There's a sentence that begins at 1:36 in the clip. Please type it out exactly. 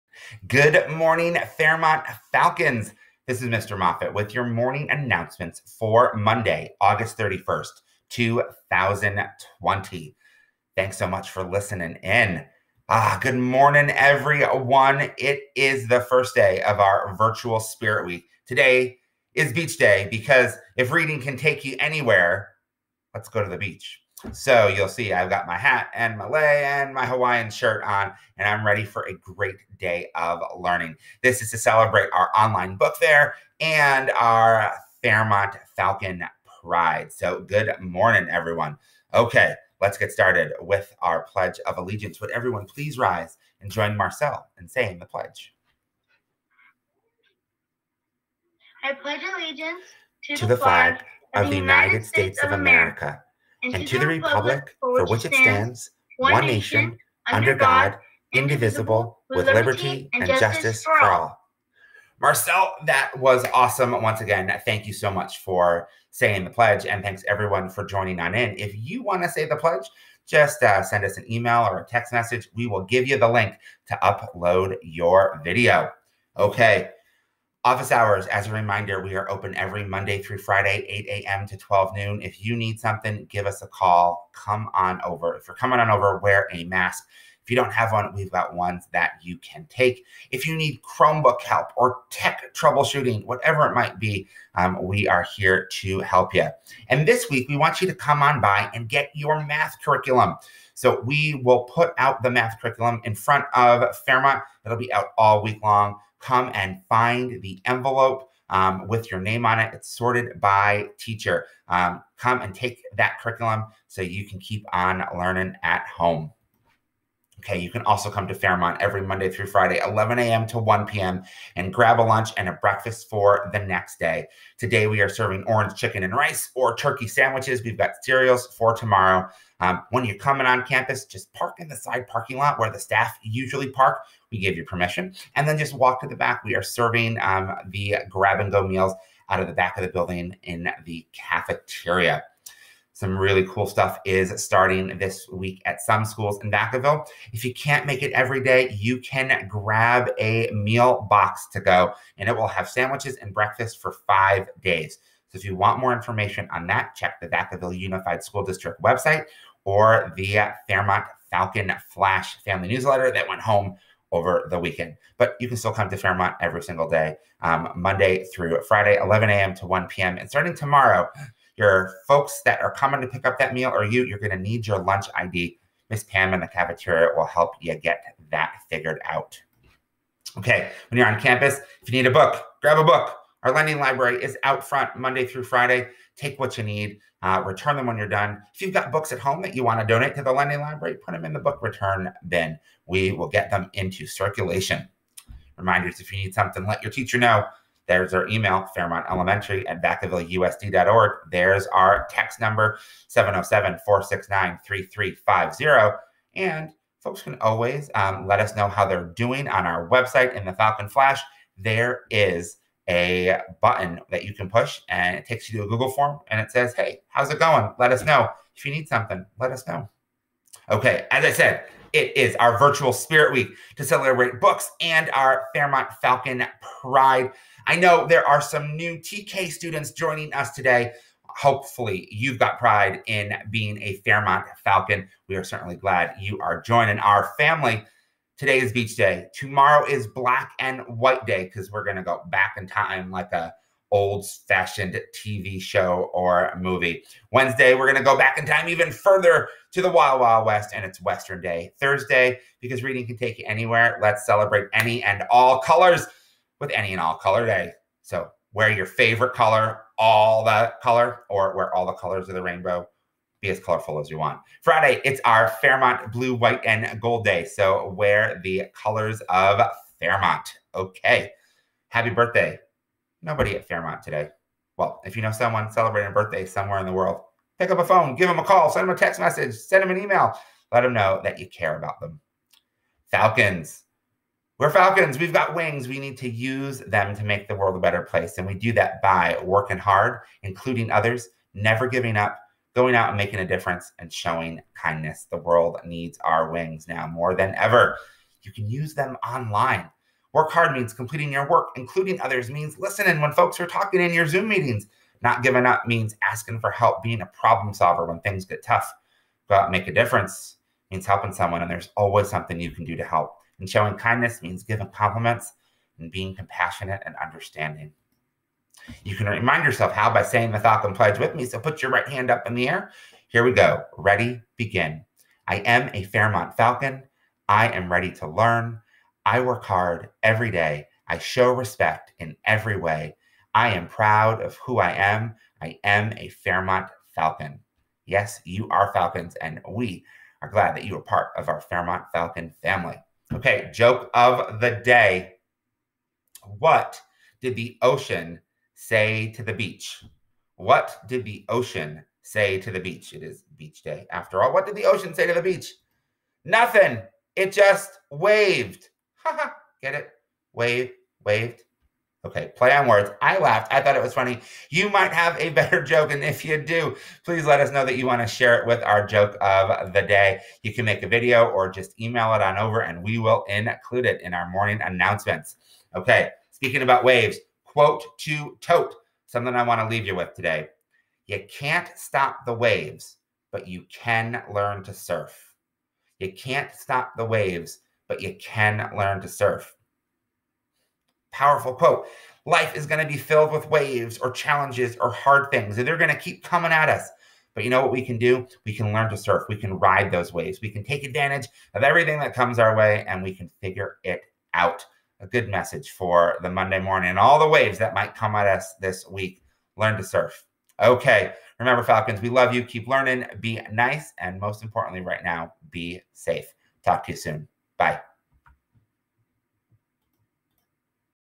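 And this week, we want you to come on by and get your math curriculum.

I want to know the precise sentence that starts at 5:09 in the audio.
Go out and make a difference means helping someone, and there's always something you can do to help.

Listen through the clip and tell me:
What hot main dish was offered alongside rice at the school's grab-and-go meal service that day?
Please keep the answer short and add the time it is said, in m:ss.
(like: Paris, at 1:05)
Orange chicken, at 2:05.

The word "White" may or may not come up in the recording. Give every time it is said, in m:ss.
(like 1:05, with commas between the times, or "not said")
4:00, 4:26.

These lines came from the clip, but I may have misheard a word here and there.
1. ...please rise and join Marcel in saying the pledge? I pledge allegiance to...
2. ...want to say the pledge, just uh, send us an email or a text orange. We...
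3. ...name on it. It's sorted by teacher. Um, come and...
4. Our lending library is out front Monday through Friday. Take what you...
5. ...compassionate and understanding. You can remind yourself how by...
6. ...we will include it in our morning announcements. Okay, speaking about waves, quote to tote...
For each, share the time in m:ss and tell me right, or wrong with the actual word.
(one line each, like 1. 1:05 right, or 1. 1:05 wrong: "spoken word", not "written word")
1. 0:42 right
2. 1:09 wrong: "message", not "orange"
3. 1:49 right
4. 3:03 right
5. 5:16 right
6. 6:13 right.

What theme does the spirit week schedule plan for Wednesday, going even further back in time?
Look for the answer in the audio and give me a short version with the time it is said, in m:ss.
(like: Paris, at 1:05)
Western Day, at 4:11.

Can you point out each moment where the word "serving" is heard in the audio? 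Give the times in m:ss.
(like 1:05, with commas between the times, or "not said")
2:05, 2:16.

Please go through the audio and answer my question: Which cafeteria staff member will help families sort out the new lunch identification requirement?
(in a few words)
Miss Pam.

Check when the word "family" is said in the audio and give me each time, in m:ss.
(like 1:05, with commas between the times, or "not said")
2:42, 3:57, 5:42.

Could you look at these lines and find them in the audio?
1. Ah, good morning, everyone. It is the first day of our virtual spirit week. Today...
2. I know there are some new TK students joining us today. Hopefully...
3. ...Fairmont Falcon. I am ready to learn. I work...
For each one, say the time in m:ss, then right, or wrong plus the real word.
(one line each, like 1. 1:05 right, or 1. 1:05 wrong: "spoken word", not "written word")
1. 0:12 right
2. 3:47 right
3. 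5:26 right.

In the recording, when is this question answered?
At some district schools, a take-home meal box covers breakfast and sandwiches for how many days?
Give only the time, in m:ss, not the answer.
2:34.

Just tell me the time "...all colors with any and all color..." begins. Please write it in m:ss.
4:15.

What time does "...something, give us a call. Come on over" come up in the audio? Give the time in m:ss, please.
1:22.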